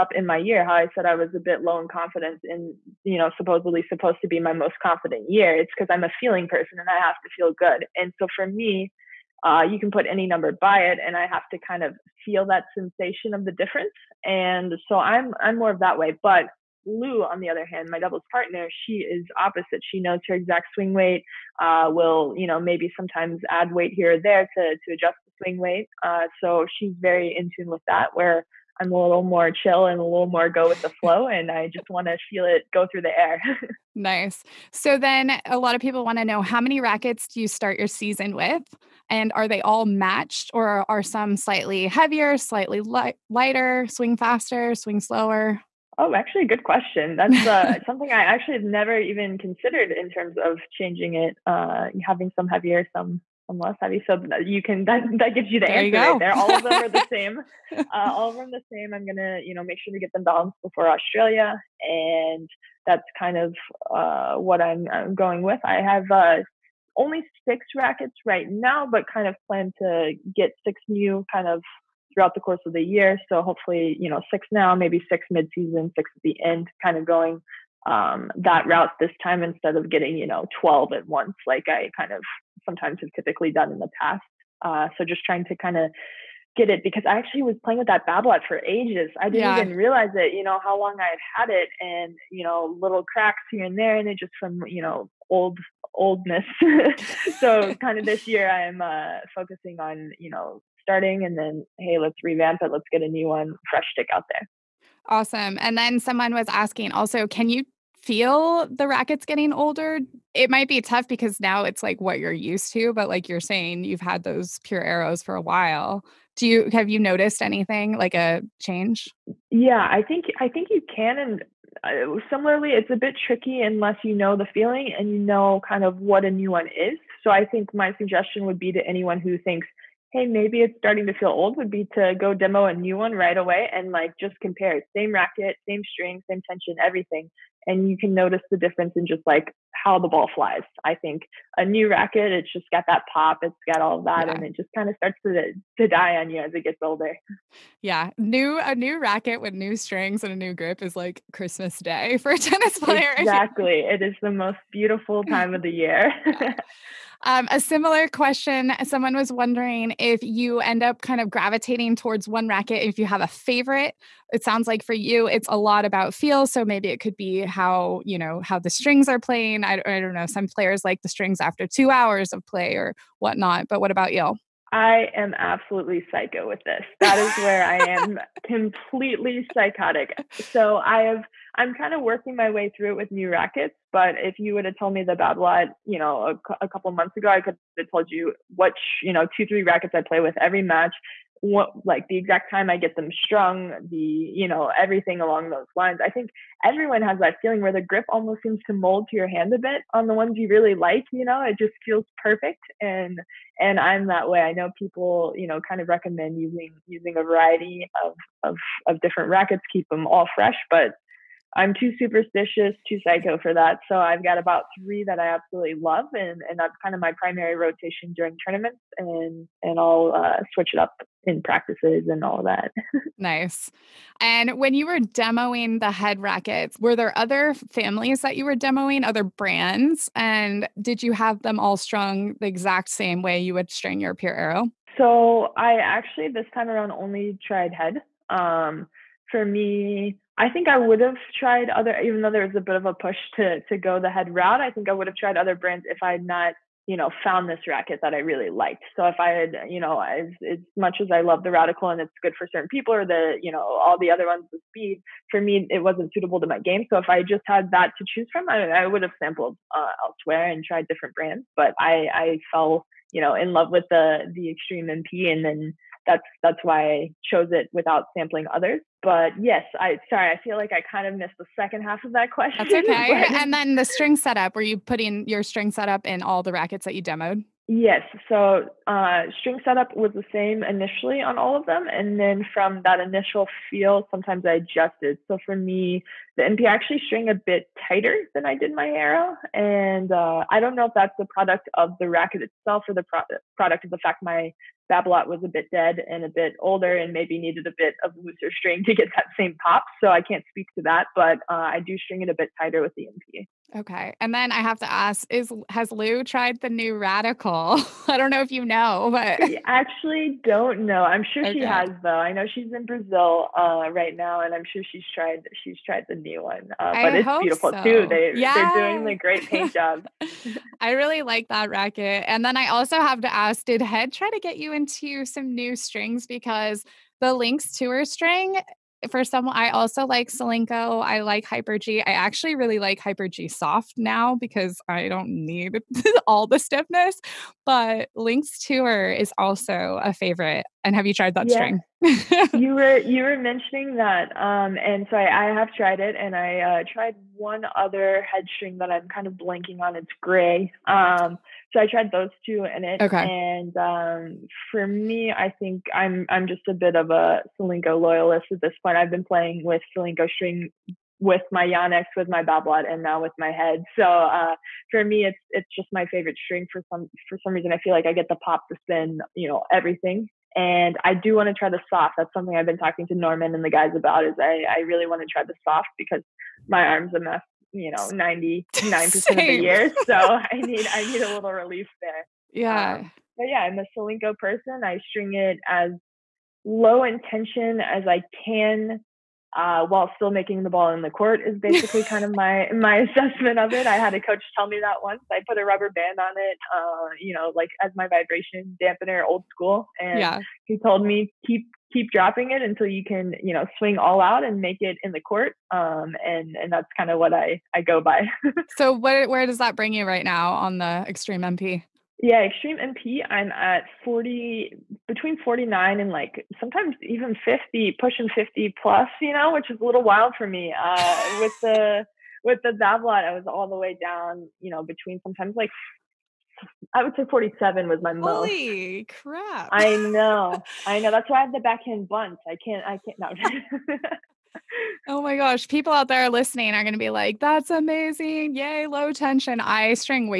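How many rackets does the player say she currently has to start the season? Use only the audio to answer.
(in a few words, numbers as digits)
6.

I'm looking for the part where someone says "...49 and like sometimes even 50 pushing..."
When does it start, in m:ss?
6:55.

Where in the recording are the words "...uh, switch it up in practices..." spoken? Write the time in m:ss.
3:40.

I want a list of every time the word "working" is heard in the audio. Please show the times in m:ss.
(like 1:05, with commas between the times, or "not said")
3:02.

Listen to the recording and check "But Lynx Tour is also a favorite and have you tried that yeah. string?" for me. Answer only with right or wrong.
right.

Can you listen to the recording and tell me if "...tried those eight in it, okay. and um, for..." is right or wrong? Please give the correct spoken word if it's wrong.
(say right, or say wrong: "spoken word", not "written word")
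wrong: "two", not "eight".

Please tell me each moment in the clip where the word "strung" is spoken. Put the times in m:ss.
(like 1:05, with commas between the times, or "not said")
3:13, 3:51.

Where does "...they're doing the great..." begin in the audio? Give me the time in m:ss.
5:18.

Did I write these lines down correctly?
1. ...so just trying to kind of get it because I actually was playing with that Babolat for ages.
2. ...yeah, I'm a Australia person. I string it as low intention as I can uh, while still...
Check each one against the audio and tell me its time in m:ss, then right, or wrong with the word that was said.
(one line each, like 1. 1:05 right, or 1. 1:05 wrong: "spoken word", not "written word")
1. 1:24 right
2. 6:23 wrong: "Solinco", not "Australia".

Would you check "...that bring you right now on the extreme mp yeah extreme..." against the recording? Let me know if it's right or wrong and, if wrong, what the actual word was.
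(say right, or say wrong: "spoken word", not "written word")
right.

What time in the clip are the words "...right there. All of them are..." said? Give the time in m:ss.
0:55.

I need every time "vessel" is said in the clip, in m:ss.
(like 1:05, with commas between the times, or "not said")
not said.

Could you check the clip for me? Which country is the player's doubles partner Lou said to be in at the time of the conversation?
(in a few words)
Brazil.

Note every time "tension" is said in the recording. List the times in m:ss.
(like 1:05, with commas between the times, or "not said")
2:16, 7:19.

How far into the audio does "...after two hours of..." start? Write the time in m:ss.
2:51.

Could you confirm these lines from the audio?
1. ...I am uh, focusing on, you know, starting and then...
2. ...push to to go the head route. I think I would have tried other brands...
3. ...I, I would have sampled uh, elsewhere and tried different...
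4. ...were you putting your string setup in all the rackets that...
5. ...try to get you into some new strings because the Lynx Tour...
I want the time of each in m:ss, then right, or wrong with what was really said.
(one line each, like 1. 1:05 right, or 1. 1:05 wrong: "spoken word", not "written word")
1. 1:38 right
2. 4:02 right
3. 4:18 right
4. 4:34 right
5. 5:24 right.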